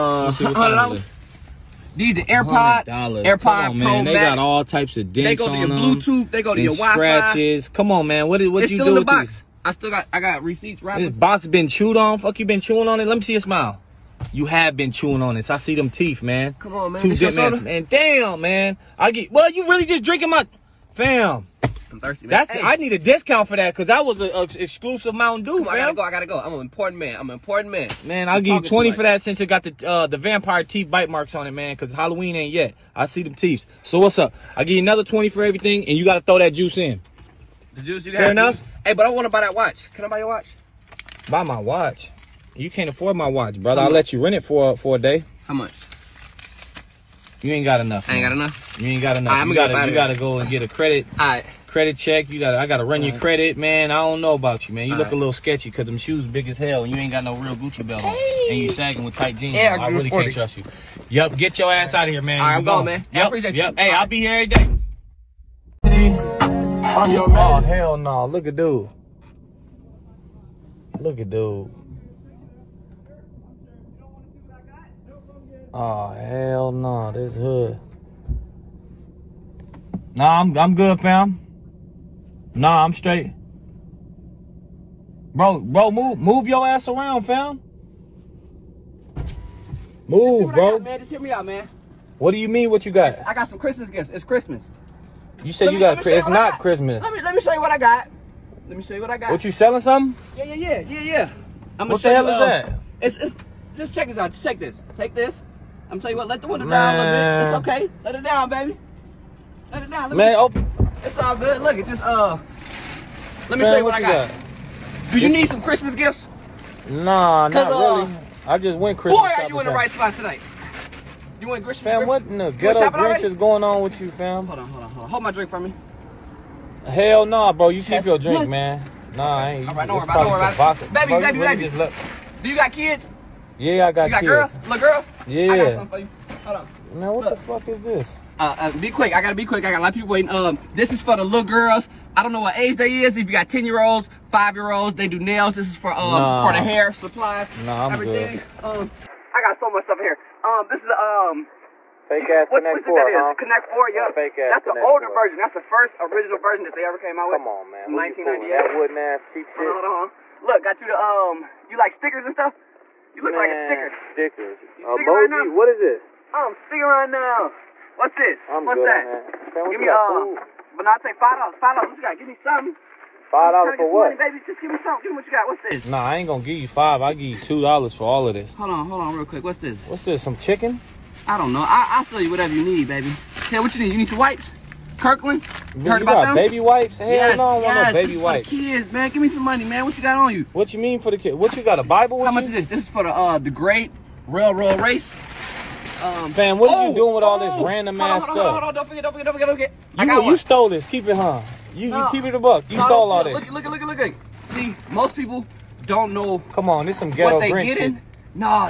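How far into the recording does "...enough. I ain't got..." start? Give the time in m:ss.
0:47.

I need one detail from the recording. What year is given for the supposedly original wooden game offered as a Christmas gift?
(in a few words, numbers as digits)
1998.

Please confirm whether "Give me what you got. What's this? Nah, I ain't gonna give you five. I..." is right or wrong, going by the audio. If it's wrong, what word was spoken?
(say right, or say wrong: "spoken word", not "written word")
right.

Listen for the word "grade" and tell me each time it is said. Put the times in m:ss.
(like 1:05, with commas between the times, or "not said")
not said.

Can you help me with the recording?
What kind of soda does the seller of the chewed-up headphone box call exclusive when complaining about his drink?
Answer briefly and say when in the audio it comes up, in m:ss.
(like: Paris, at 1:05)
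Mountain Dew, at 0:25.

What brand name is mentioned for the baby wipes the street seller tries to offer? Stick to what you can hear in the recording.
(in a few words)
Kirkland.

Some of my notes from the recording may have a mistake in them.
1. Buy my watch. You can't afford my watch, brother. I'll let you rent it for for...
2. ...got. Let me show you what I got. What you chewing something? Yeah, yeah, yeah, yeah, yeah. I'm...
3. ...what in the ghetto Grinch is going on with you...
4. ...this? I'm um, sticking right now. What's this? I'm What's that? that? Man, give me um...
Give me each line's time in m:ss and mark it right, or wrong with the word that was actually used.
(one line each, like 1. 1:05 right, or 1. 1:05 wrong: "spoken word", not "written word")
1. 0:41 right
2. 1:37 wrong: "selling", not "chewing"
3. 2:02 right
4. 2:45 right.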